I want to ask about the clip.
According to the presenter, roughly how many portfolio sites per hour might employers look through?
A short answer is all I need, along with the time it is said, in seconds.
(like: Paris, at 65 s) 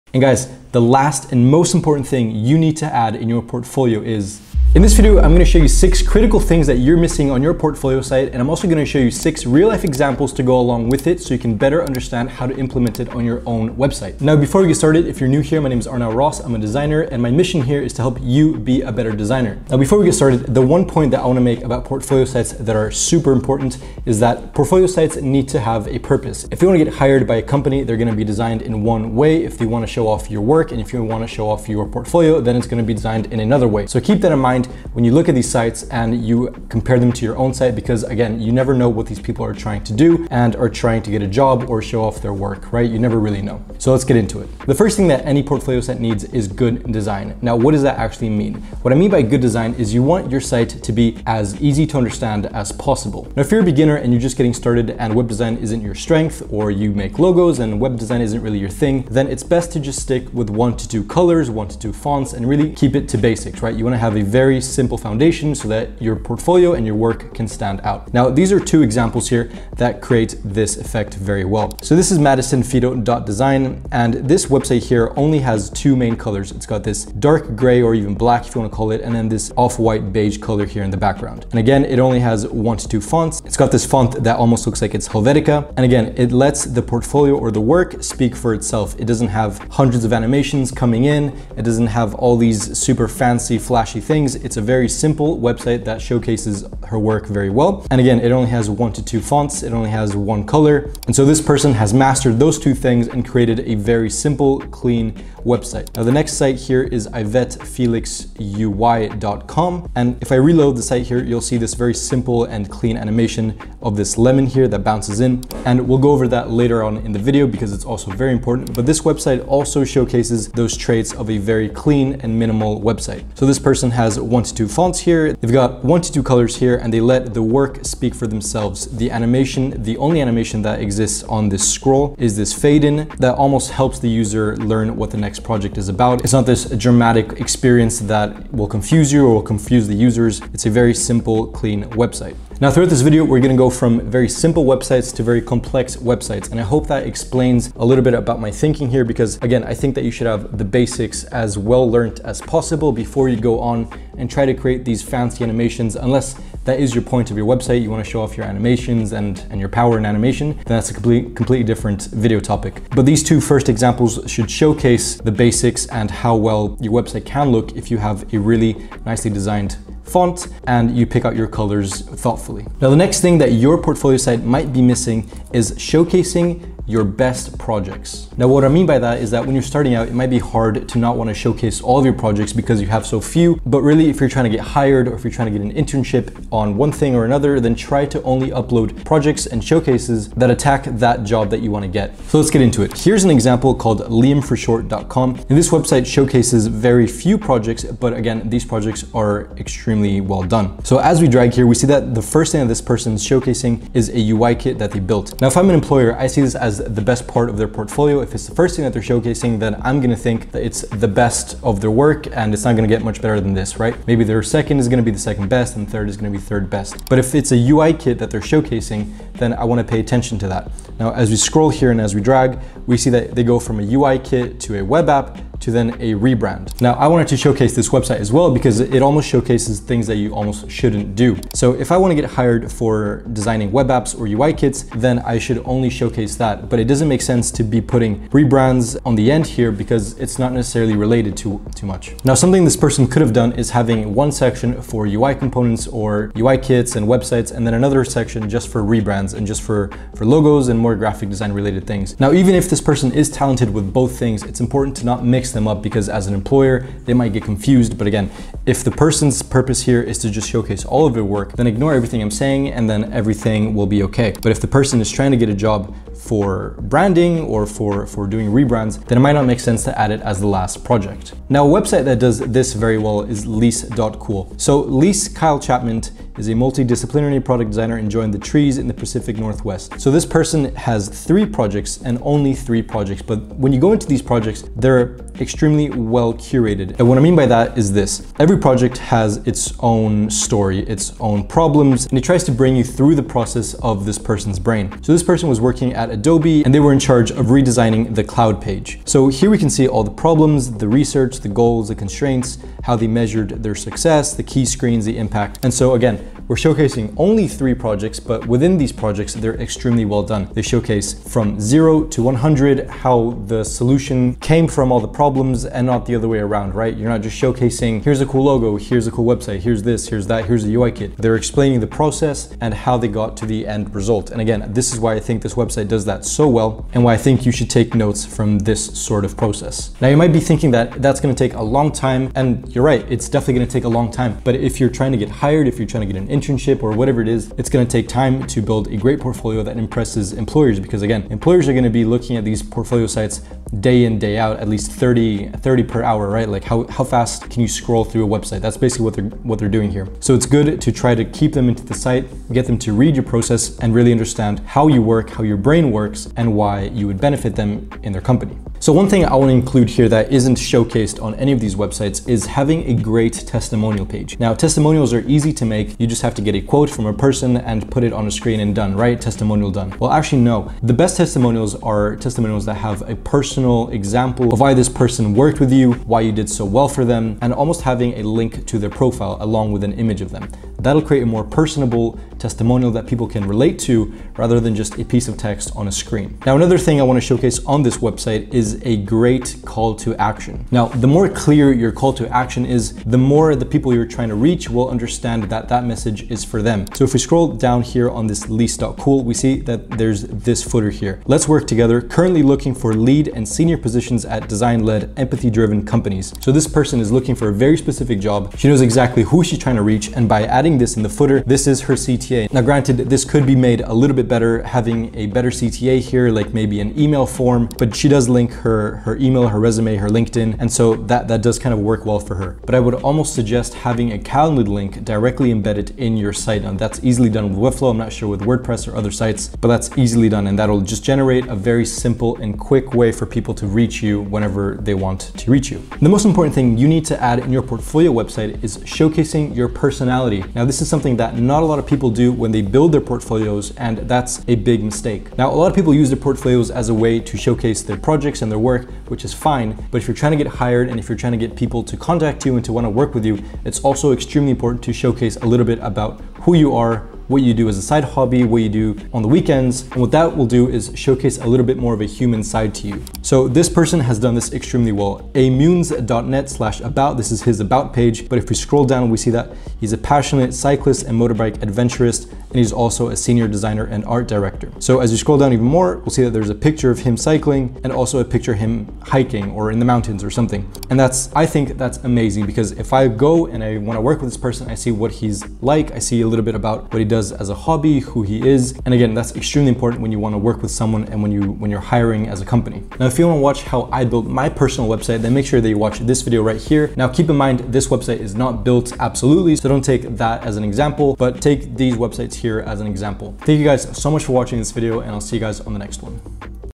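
30, at 345 s.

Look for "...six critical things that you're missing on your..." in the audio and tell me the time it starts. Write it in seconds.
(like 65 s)
5 s.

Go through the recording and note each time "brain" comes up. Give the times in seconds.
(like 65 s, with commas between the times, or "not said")
294 s, 355 s.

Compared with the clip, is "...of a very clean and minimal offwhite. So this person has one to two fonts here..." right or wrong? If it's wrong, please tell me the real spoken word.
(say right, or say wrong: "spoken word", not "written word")
wrong: "website", not "offwhite".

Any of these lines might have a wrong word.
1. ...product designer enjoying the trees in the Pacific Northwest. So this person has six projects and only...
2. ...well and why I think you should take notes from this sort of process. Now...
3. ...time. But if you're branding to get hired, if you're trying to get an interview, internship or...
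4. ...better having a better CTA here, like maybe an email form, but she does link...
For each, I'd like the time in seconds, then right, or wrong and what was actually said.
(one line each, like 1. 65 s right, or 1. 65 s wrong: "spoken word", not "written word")
1. 277 s wrong: "three", not "six"
2. 326 s right
3. 334 s wrong: "trying", not "branding"
4. 414 s right.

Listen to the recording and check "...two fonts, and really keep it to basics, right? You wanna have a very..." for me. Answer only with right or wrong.
right.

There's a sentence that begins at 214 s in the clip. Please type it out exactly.
Maybe their second is gonna be the second best and third is gonna be third best.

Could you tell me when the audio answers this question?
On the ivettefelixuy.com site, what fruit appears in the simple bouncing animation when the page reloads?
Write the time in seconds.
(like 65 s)
114 s.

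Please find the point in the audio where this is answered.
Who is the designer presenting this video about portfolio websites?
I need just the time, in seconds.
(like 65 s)
15 s.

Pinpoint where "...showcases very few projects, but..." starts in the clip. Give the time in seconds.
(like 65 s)
196 s.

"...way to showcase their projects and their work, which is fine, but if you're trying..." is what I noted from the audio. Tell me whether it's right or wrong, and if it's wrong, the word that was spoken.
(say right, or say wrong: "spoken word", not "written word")
right.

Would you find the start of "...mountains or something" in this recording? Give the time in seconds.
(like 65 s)
479 s.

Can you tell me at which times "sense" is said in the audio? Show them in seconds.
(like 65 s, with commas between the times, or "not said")
237 s, 269 s.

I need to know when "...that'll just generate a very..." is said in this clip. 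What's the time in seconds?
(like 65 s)
430 s.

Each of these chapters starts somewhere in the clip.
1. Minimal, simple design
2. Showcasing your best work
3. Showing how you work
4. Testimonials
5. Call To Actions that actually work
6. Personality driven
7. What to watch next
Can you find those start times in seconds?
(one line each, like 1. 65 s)
1. 72 s
2. 176 s
3. 260 s
4. 364 s
5. 390 s
6. 441 s
7. 492 s.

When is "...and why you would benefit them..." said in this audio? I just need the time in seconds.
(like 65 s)
356 s.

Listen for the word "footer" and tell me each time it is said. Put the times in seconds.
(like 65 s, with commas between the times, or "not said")
400 s, 411 s.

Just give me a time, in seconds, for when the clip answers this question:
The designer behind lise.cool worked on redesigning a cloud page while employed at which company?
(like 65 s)
296 s.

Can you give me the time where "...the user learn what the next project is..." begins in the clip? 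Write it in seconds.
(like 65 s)
133 s.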